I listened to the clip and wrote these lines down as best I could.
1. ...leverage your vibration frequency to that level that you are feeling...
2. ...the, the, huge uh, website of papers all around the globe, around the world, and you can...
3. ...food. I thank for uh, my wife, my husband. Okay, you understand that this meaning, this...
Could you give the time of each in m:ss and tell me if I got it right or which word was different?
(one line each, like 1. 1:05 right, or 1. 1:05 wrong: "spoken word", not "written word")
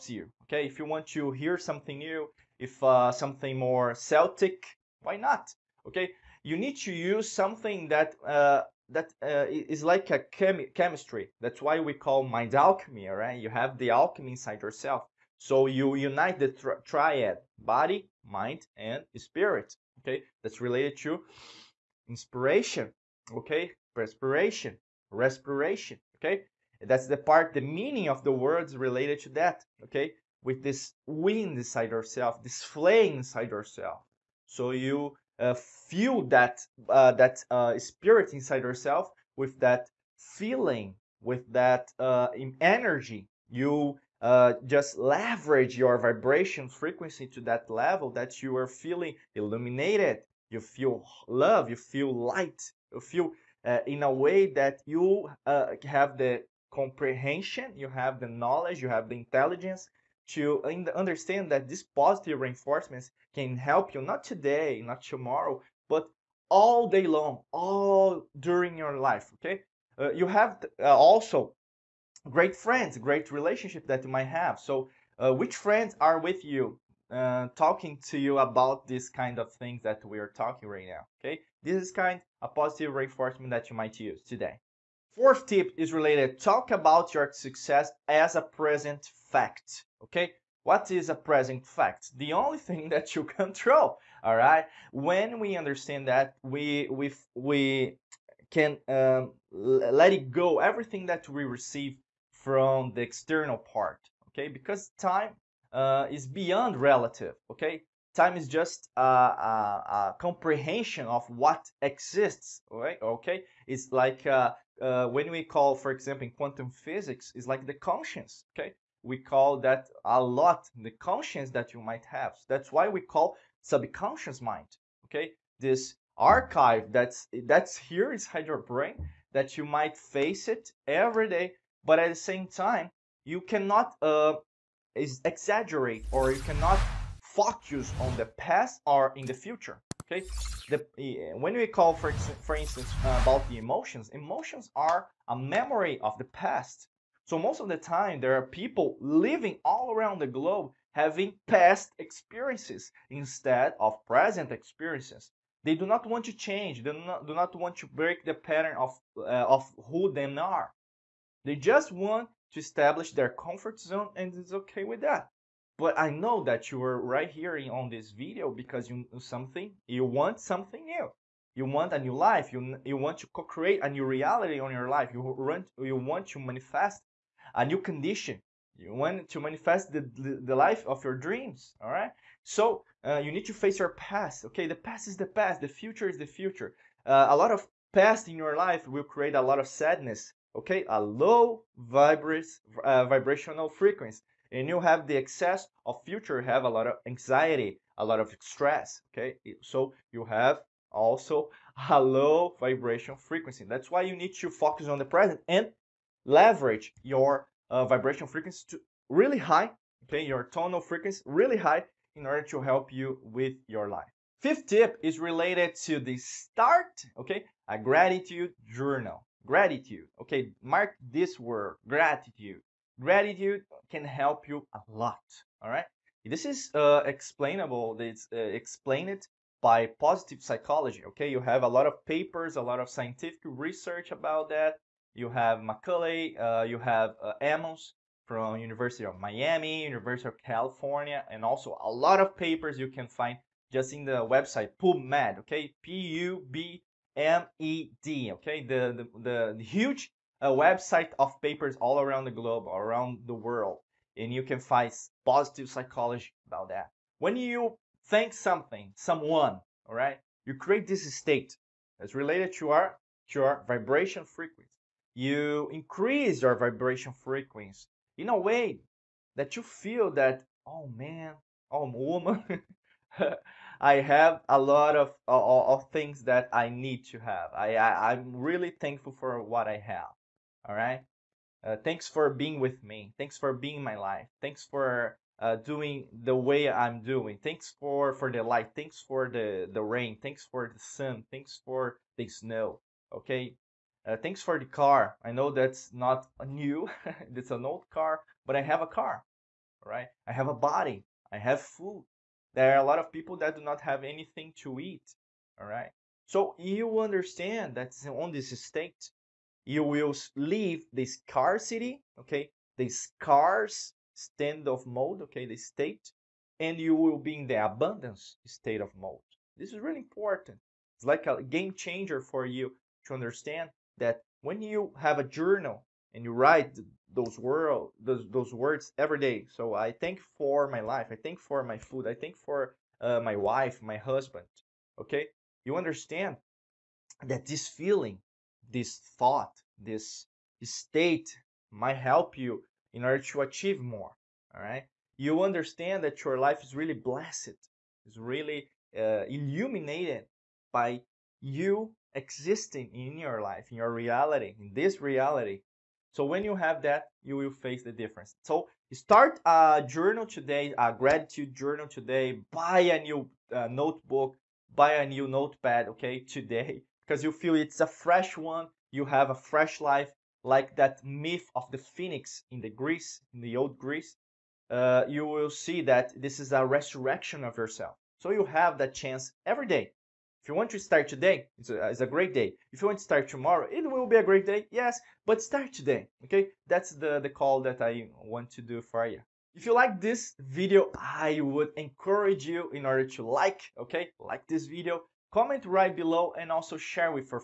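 1. 0:44 right
2. 4:09 right
3. 5:31 wrong: "feeling", not "meaning".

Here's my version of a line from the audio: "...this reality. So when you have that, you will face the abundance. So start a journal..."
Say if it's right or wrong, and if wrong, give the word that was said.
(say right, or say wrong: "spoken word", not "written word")
wrong: "difference", not "abundance".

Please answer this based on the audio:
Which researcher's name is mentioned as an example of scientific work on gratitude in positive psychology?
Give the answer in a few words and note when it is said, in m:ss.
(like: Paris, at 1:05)
McCullough, at 3:55.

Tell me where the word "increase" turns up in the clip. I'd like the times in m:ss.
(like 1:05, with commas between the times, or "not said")
4:25.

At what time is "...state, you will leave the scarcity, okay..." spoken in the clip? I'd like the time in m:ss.
5:08.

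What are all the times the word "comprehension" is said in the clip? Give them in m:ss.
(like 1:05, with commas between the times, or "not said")
0:56, 1:50.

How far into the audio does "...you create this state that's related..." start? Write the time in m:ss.
4:20.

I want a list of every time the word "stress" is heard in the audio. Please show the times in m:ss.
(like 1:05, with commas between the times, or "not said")
3:18.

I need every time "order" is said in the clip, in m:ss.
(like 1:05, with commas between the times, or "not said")
3:32, 5:43, 6:32.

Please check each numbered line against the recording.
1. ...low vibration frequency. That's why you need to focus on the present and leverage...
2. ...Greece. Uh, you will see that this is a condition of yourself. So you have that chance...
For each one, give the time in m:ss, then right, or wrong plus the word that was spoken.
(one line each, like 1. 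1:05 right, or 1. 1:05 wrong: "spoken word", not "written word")
1. 3:22 right
2. 6:13 wrong: "resurrection", not "condition".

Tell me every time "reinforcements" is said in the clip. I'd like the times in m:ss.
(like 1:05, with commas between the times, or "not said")
1:02, 1:22.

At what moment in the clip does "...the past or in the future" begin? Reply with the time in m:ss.
2:18.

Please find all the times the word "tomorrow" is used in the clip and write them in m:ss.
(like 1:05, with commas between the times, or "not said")
1:05, 6:23.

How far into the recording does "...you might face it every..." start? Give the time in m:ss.
2:09.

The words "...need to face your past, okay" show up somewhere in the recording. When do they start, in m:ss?
3:03.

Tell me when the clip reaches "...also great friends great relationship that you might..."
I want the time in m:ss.
1:10.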